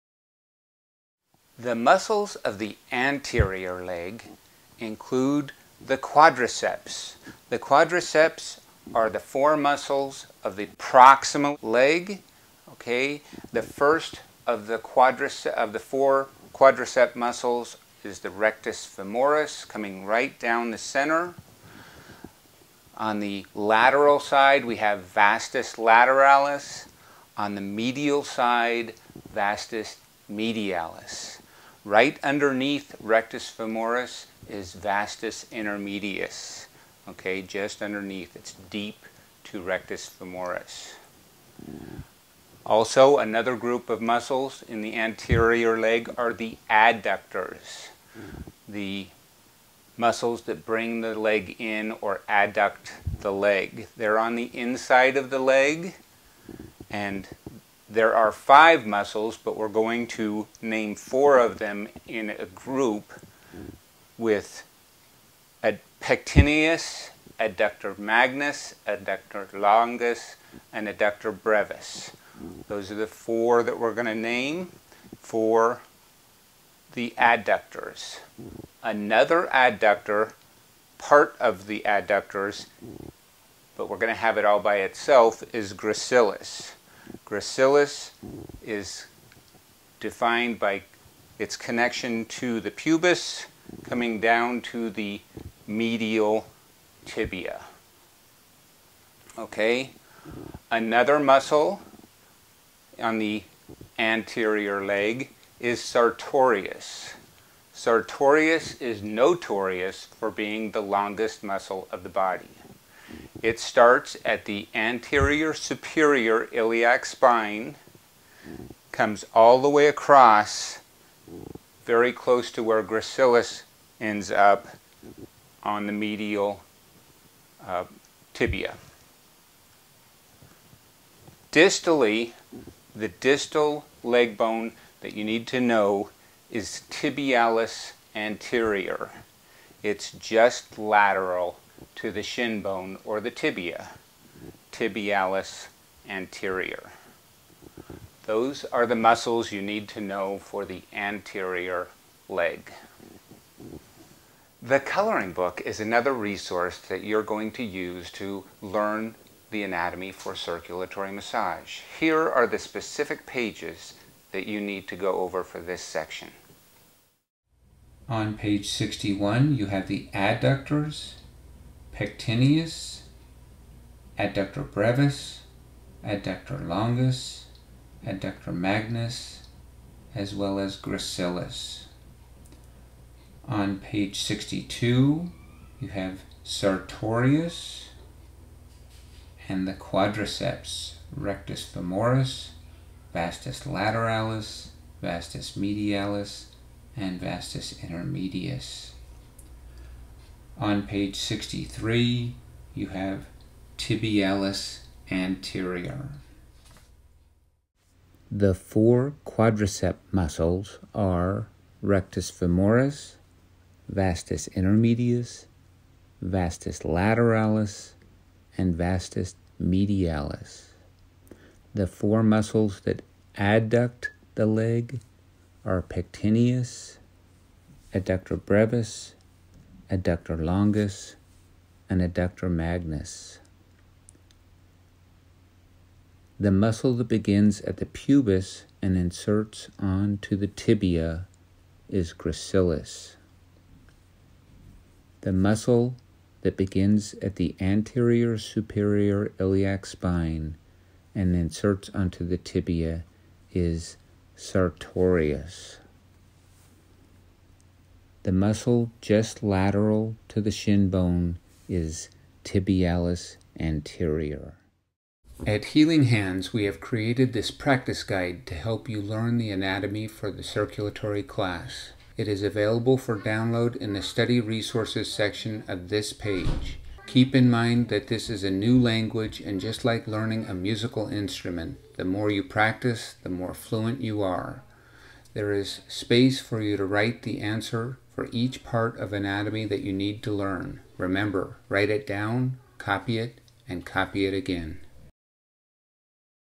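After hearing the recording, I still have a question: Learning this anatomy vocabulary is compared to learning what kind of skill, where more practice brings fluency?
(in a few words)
A musical instrument.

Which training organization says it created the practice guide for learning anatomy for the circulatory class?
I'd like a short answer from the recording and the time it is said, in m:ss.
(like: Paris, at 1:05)
Healing Hands, at 4:25.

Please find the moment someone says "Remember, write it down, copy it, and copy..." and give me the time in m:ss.
4:50.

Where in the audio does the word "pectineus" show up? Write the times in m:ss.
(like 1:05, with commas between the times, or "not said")
1:06, 2:52, 3:45.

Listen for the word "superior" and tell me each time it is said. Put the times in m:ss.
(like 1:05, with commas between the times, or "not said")
1:55, 4:08.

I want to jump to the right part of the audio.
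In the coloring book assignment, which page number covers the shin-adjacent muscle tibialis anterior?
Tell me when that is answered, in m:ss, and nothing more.
3:20.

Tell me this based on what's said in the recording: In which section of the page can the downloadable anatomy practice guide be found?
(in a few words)
Study Resources.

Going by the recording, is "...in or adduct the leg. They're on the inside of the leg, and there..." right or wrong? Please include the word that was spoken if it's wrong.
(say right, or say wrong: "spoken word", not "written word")
right.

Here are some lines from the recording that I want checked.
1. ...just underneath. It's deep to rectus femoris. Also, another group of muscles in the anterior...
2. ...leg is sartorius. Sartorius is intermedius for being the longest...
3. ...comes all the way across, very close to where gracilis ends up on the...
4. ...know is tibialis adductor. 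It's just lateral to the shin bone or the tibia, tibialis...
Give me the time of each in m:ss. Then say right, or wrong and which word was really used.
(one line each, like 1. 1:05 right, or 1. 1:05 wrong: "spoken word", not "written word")
1. 0:37 right
2. 1:44 wrong: "notorious", not "intermedius"
3. 1:58 right
4. 2:15 wrong: "anterior", not "adductor".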